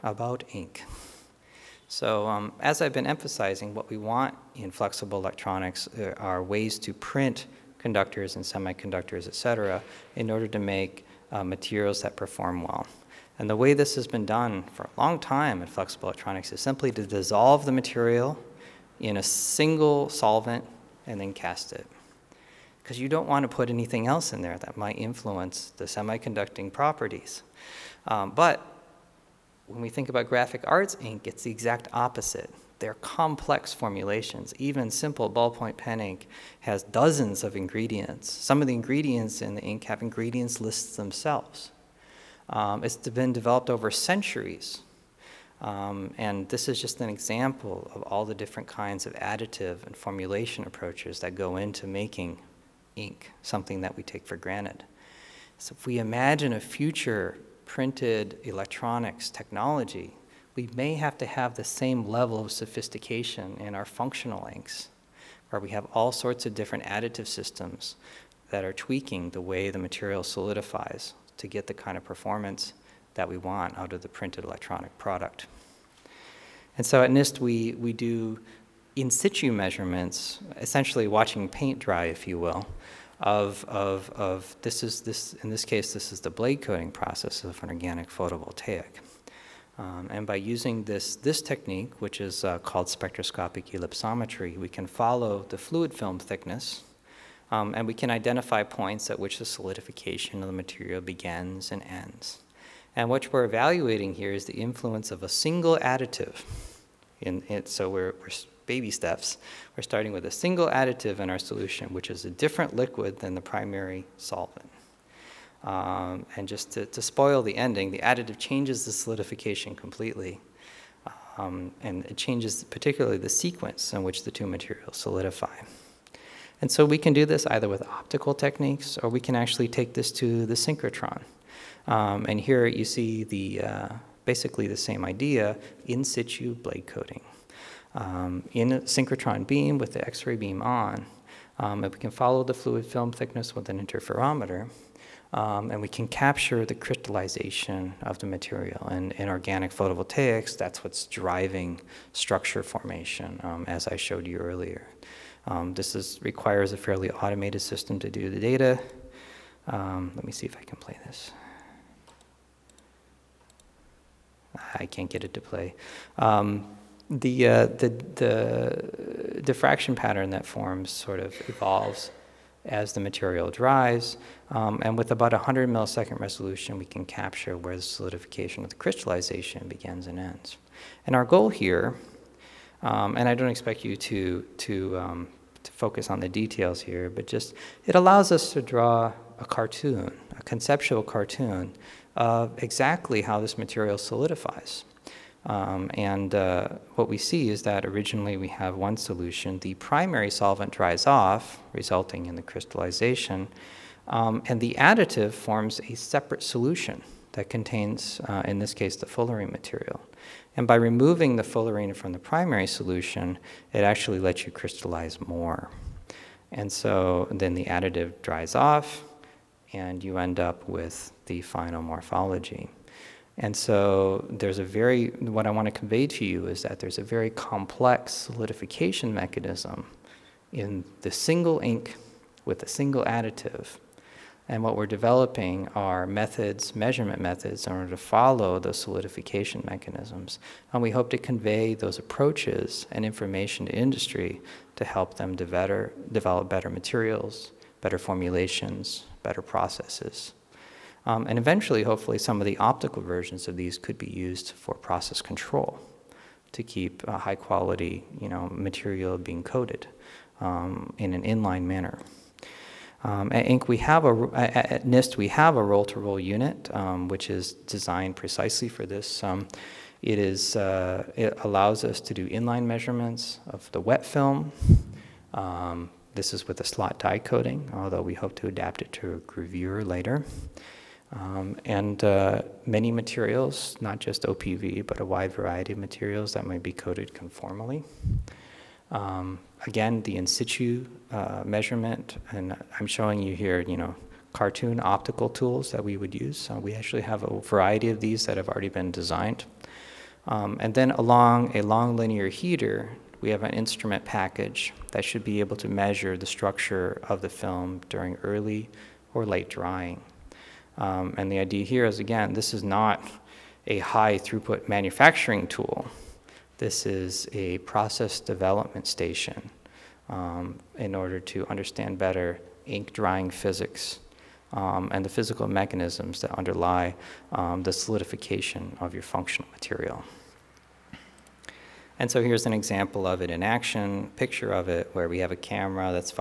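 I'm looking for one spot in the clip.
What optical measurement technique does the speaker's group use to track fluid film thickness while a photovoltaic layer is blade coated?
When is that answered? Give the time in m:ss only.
1:32.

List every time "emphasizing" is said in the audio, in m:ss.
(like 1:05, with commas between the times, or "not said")
0:03.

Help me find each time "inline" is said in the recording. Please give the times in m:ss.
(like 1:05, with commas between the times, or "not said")
4:21, 4:32.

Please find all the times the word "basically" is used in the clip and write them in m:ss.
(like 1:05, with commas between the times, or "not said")
2:14.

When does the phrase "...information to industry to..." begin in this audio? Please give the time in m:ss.
4:03.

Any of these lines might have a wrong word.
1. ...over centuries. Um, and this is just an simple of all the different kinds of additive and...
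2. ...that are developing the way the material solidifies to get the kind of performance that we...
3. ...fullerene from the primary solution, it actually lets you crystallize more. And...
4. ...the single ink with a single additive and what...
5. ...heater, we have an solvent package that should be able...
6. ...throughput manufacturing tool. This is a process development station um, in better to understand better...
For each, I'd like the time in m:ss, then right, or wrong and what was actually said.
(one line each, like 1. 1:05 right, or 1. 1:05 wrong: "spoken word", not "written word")
1. 0:43 wrong: "example", not "simple"
2. 1:08 wrong: "tweaking", not "developing"
3. 3:31 right
4. 3:50 right
5. 5:02 wrong: "instrument", not "solvent"
6. 5:14 wrong: "order", not "better".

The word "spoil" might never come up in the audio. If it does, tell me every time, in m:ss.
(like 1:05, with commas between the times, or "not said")
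1:57.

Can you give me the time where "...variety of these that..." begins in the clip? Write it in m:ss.
4:57.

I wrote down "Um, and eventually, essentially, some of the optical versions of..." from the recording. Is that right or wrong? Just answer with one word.
wrong.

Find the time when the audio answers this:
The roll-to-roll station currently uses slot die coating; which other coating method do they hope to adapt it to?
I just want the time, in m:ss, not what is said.
4:39.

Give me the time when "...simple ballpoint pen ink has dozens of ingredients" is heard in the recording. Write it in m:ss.
0:34.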